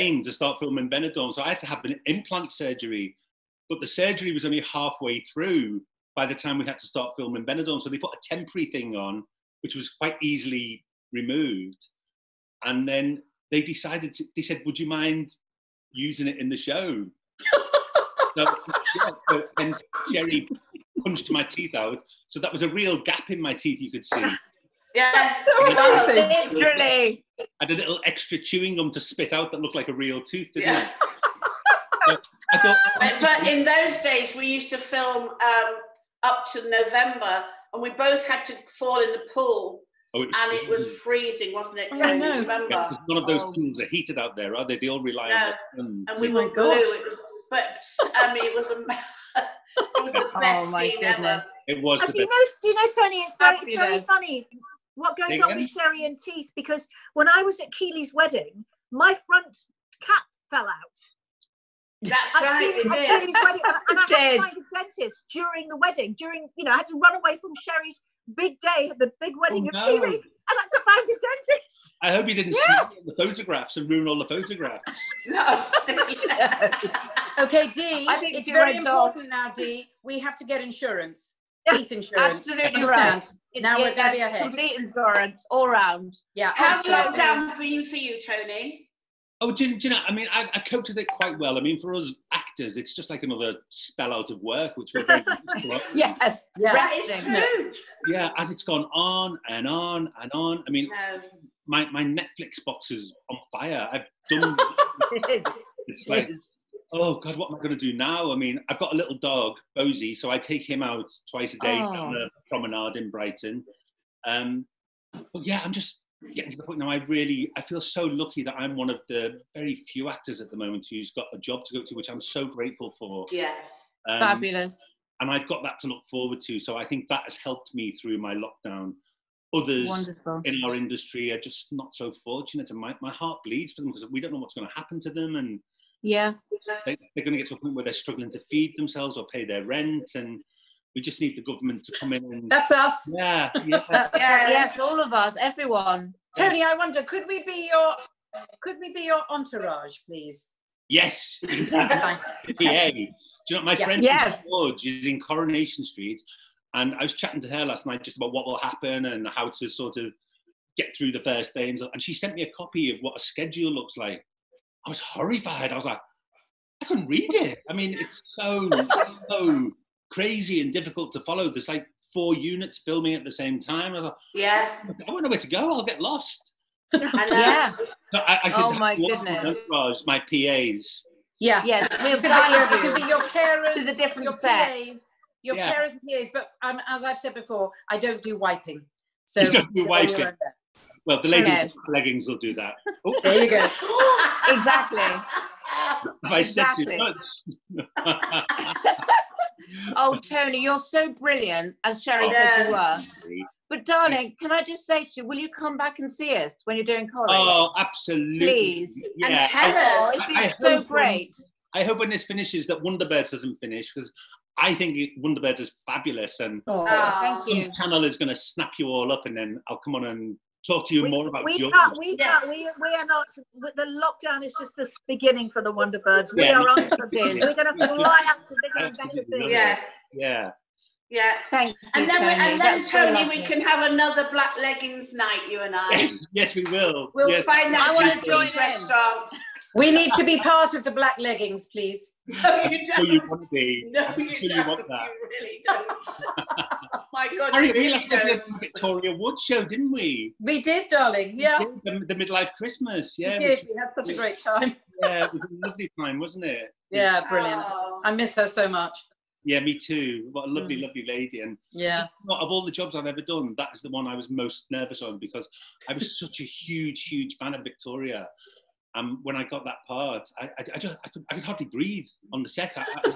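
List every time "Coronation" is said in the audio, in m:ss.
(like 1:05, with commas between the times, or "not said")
2:35.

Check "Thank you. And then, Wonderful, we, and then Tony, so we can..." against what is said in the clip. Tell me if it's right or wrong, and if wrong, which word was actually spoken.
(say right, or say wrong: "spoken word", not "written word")
wrong: "Tony", not "Wonderful".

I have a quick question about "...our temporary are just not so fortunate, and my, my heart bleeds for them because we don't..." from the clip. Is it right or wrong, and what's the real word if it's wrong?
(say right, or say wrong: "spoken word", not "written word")
wrong: "industry", not "temporary".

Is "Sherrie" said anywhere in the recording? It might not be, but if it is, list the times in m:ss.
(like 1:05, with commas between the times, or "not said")
0:20, 0:55, 1:07, 3:22.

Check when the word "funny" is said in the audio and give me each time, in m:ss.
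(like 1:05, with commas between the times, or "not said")
0:54.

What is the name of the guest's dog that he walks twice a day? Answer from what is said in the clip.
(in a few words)
Bosie.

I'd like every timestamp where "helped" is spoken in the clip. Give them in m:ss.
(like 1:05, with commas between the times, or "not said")
2:07.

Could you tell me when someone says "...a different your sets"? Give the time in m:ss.
3:03.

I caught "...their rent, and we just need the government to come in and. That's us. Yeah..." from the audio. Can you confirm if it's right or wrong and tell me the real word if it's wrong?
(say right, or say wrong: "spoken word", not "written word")
right.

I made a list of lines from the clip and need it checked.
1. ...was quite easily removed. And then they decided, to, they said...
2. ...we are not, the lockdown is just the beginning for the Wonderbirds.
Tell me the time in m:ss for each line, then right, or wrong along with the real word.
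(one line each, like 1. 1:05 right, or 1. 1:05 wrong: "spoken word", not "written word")
1. 0:09 right
2. 3:42 right.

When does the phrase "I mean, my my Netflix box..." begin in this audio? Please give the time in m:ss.
1:40.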